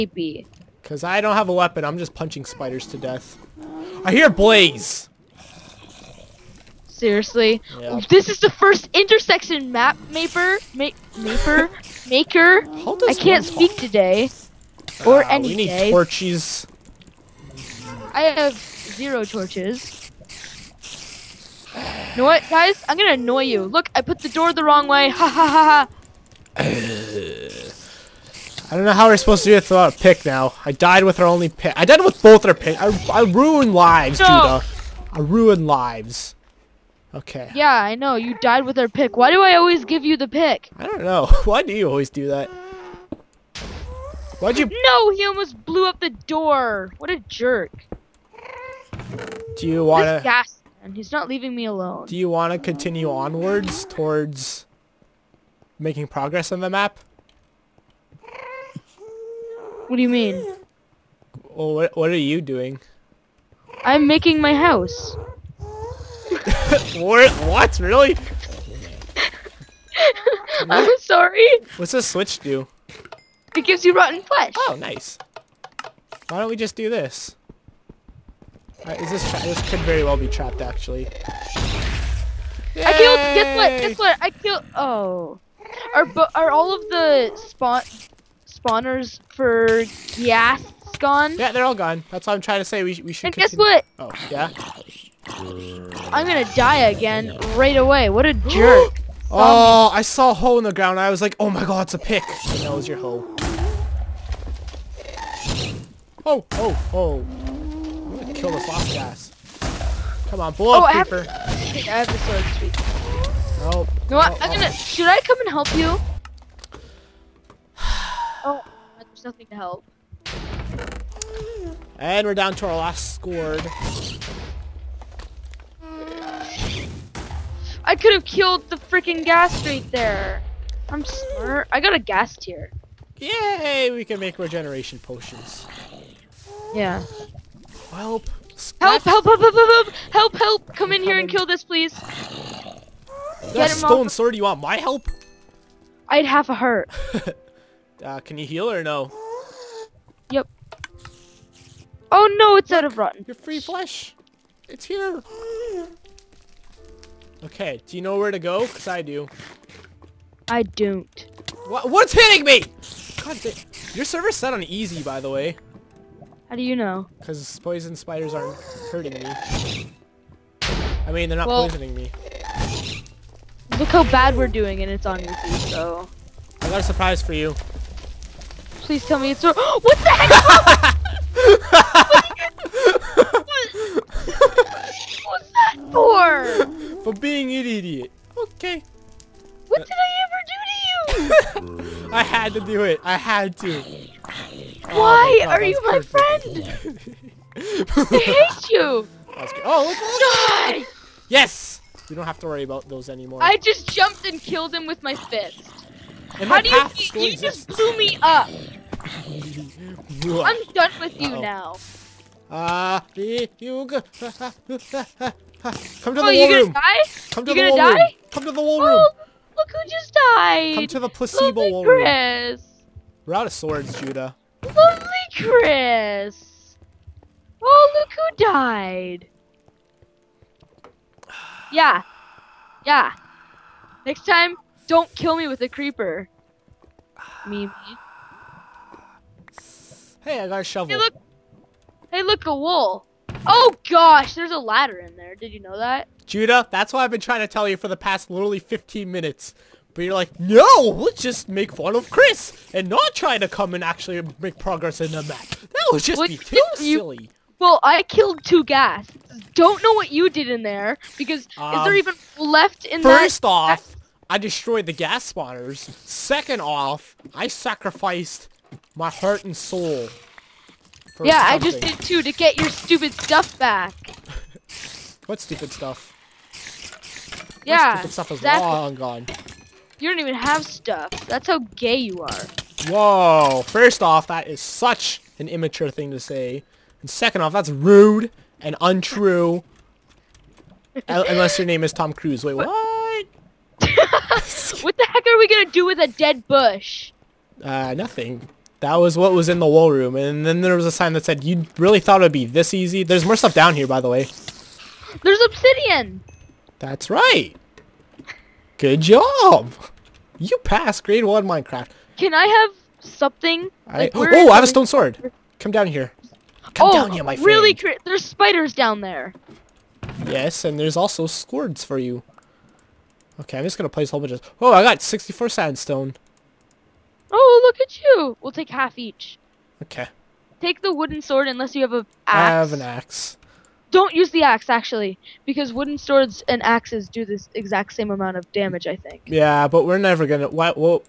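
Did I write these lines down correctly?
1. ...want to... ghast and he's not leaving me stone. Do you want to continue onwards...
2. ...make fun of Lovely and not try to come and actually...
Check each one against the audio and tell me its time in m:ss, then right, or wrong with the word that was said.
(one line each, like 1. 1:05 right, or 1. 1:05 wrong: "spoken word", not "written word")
1. 0:49 wrong: "alone", not "stone"
2. 4:11 wrong: "Chris", not "Lovely".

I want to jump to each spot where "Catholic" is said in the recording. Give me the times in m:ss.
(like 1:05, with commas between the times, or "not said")
not said.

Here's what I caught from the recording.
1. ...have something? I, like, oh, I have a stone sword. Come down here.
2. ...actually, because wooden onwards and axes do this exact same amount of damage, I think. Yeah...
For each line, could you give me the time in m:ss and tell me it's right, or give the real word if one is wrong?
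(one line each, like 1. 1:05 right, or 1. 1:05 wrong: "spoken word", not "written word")
1. 5:12 right
2. 5:34 wrong: "swords", not "onwards".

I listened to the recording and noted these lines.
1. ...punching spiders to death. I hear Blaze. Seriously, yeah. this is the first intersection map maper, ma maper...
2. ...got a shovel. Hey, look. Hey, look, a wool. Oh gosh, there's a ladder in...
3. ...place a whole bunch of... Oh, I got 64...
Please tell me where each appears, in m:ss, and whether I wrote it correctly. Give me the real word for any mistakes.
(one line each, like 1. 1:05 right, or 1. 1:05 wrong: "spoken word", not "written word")
1. 0:02 right
2. 4:00 right
3. 5:23 right.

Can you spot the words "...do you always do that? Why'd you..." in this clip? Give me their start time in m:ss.
0:41.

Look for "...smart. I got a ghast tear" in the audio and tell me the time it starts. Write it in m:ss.
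2:11.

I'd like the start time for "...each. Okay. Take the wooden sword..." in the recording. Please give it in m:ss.
5:28.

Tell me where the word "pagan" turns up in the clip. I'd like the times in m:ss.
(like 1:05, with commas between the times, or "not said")
not said.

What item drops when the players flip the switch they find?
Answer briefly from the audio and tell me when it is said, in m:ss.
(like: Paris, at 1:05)
rotten flesh, at 1:13.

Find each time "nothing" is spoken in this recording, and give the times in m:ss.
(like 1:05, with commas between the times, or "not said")
1:59, 4:57.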